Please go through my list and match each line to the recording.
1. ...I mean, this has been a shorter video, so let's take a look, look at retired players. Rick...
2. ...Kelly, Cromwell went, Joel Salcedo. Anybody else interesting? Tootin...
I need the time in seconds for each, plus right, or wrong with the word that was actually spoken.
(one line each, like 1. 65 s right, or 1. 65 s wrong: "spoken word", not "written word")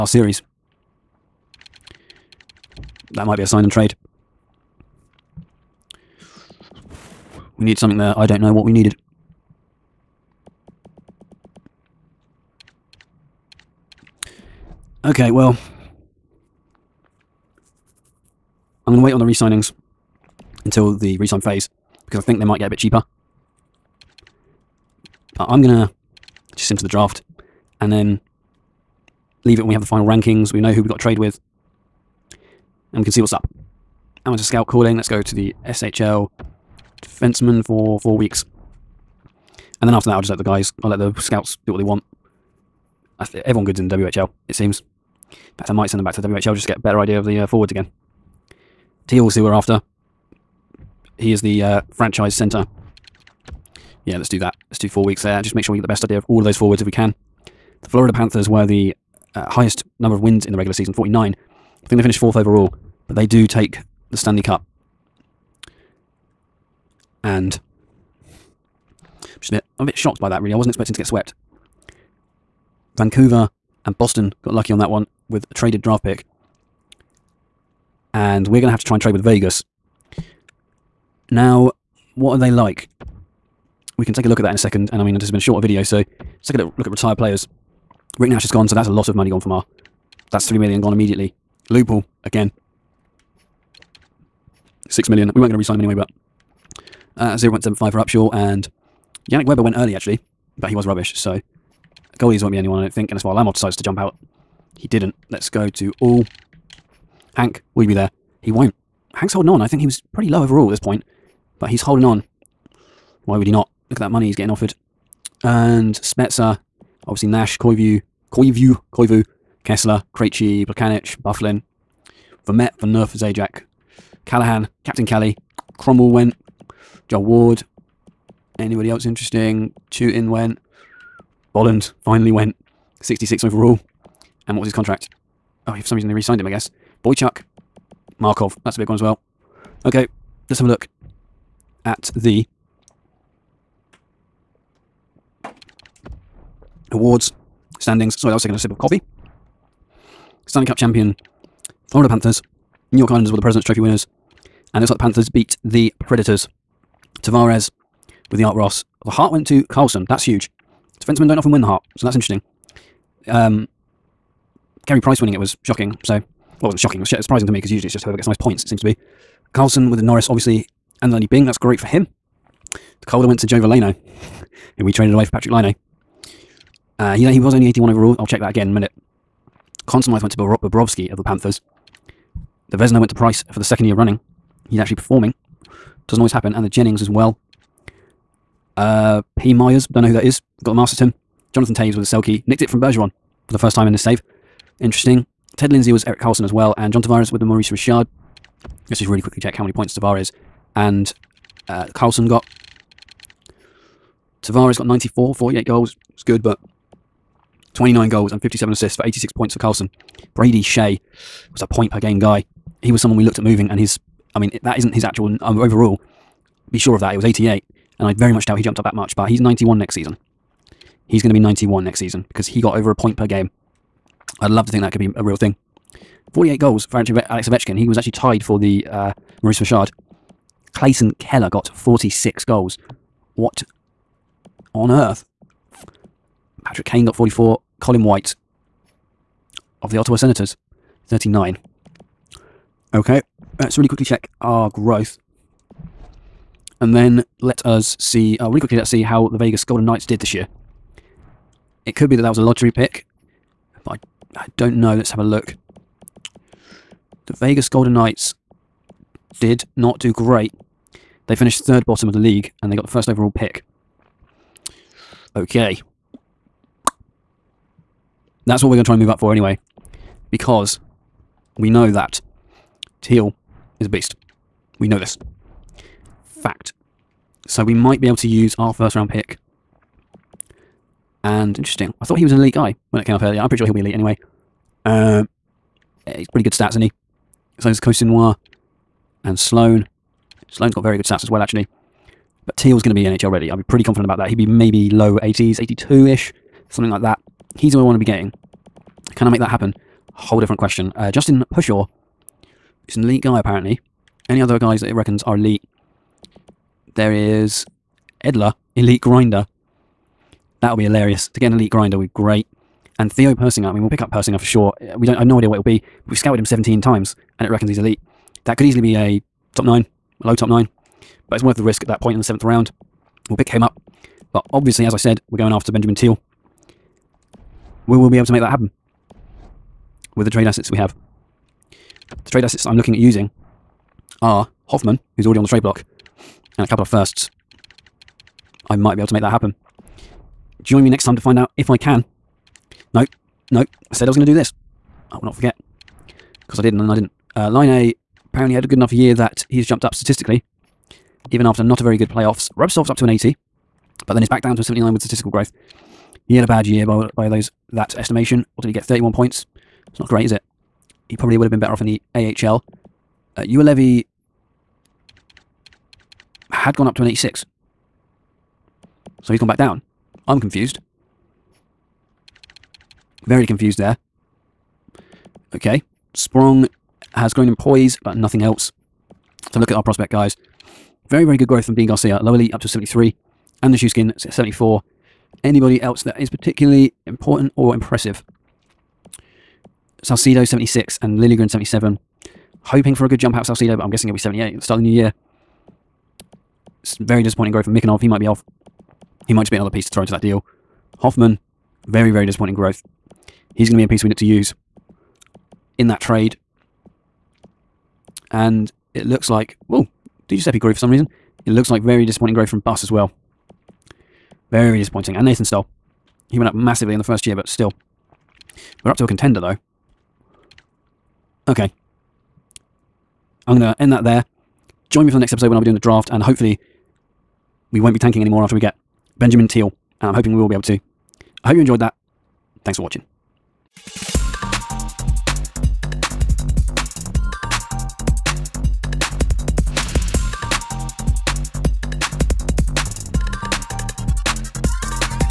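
1. 85 s right
2. 125 s wrong: "Ward", not "Salcedo".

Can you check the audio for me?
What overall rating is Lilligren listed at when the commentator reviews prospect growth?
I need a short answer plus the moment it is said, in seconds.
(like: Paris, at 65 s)
77, at 391 s.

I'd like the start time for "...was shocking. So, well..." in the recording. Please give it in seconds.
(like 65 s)
165 s.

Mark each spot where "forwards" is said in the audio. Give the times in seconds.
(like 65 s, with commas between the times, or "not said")
47 s, 56 s.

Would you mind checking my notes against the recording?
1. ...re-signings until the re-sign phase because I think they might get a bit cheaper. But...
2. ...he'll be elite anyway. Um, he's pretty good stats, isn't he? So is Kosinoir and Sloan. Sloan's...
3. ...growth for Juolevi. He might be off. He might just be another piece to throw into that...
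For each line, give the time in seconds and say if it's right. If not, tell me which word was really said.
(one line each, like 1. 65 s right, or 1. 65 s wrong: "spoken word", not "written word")
1. 19 s right
2. 283 s right
3. 397 s wrong: "Mikanov", not "Juolevi".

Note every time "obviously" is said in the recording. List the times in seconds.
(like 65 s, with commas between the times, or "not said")
117 s, 170 s, 324 s.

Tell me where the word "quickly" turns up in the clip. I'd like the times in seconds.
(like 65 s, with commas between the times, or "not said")
199 s, 243 s, 248 s.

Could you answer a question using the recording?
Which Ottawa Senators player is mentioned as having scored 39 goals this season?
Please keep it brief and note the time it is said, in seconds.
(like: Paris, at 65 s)
Colin White, at 237 s.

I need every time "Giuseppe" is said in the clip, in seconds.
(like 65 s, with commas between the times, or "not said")
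410 s.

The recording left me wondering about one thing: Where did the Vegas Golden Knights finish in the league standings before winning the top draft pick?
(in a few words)
Third bottom.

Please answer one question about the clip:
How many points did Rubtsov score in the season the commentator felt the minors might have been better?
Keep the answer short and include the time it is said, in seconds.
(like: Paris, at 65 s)
31, at 358 s.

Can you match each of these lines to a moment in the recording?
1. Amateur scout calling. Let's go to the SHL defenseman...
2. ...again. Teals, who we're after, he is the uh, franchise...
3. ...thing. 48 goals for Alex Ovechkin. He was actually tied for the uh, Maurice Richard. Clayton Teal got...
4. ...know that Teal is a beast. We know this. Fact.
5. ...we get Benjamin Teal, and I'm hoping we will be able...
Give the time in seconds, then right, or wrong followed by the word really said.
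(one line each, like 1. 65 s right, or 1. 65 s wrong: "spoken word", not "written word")
1. 34 s right
2. 47 s right
3. 225 s wrong: "Keller", not "Teal"
4. 271 s right
5. 428 s right.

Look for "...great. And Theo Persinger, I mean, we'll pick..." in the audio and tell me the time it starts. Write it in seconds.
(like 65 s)
312 s.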